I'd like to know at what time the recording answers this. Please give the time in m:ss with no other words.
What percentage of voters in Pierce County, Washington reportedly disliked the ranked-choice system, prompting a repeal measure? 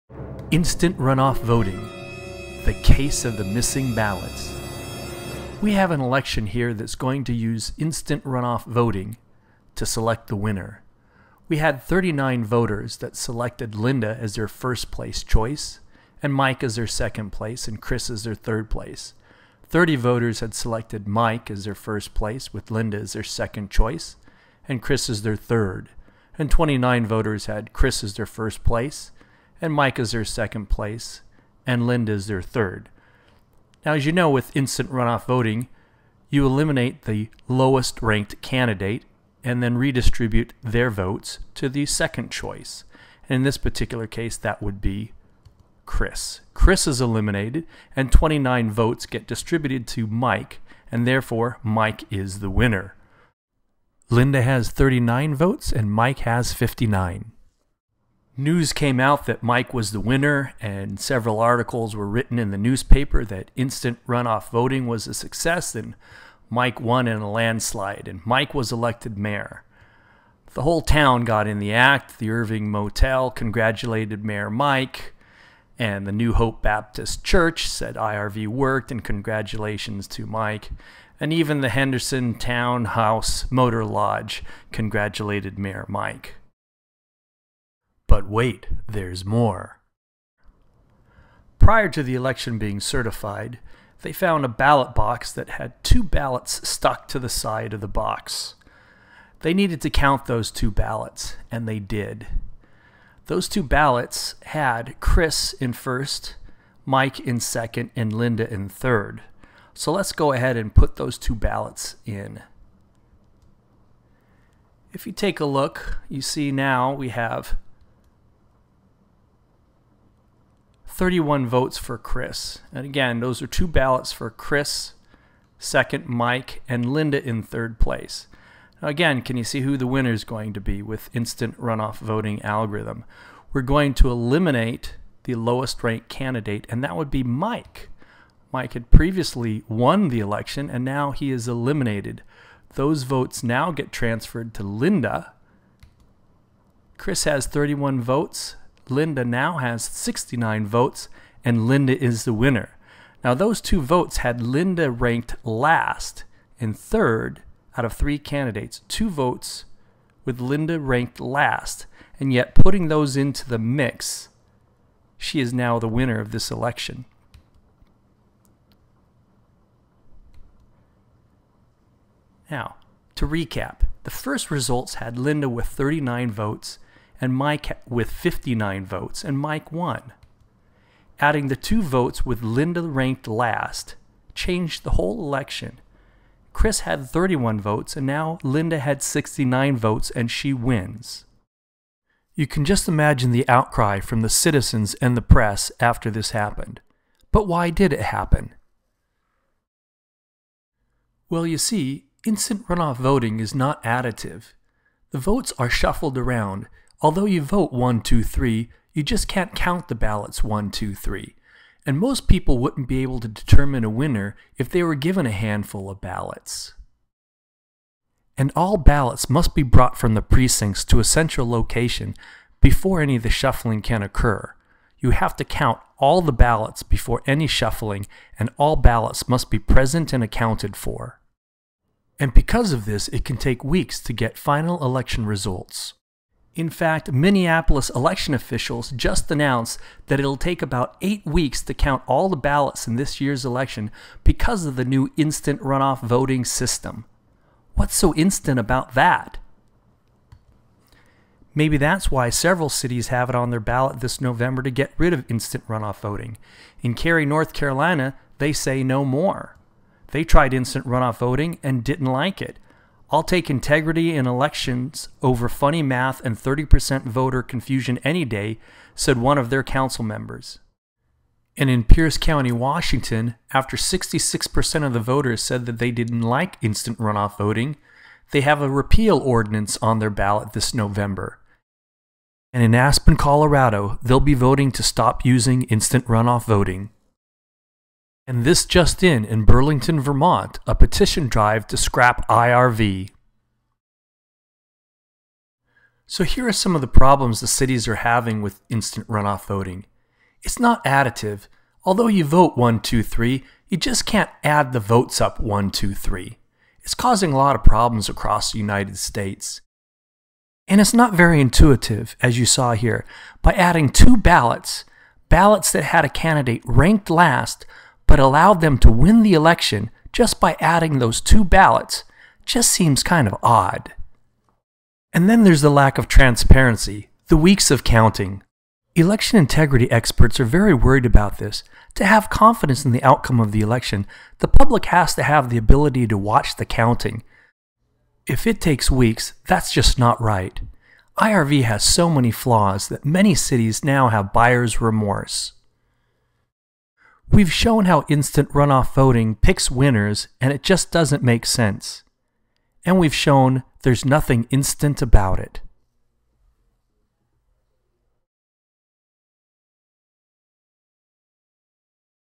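4:33.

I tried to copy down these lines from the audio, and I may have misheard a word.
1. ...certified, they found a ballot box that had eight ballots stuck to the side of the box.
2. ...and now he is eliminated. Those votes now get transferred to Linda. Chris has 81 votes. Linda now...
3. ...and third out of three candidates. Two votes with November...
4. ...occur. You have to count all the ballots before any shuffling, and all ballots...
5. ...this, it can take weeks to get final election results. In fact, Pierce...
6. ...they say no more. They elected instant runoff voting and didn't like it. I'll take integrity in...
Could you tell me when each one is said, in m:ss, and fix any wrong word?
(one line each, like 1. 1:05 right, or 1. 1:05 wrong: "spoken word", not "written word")
1. 1:32 wrong: "two", not "eight"
2. 2:20 wrong: "31", not "81"
3. 2:36 wrong: "Linda", not "November"
4. 3:44 right
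5. 3:52 wrong: "Minneapolis", not "Pierce"
6. 4:18 wrong: "tried", not "elected".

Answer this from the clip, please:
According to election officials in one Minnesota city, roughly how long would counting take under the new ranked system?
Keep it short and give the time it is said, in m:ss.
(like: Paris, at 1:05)
8 weeks, at 4:01.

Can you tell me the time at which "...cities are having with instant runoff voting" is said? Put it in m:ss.
4:57.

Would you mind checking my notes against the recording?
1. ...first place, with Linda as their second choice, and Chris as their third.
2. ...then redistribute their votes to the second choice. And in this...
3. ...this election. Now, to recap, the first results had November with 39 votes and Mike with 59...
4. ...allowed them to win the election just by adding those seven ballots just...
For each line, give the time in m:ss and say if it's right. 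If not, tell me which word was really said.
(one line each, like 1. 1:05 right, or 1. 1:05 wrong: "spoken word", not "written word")
1. 0:21 right
2. 0:39 right
3. 2:46 wrong: "Linda", not "November"
4. 5:18 wrong: "two", not "seven".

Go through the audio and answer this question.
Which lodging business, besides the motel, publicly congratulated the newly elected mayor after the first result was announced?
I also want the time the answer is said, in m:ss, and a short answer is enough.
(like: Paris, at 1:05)
Henderson Town House Motor Lodge, at 1:21.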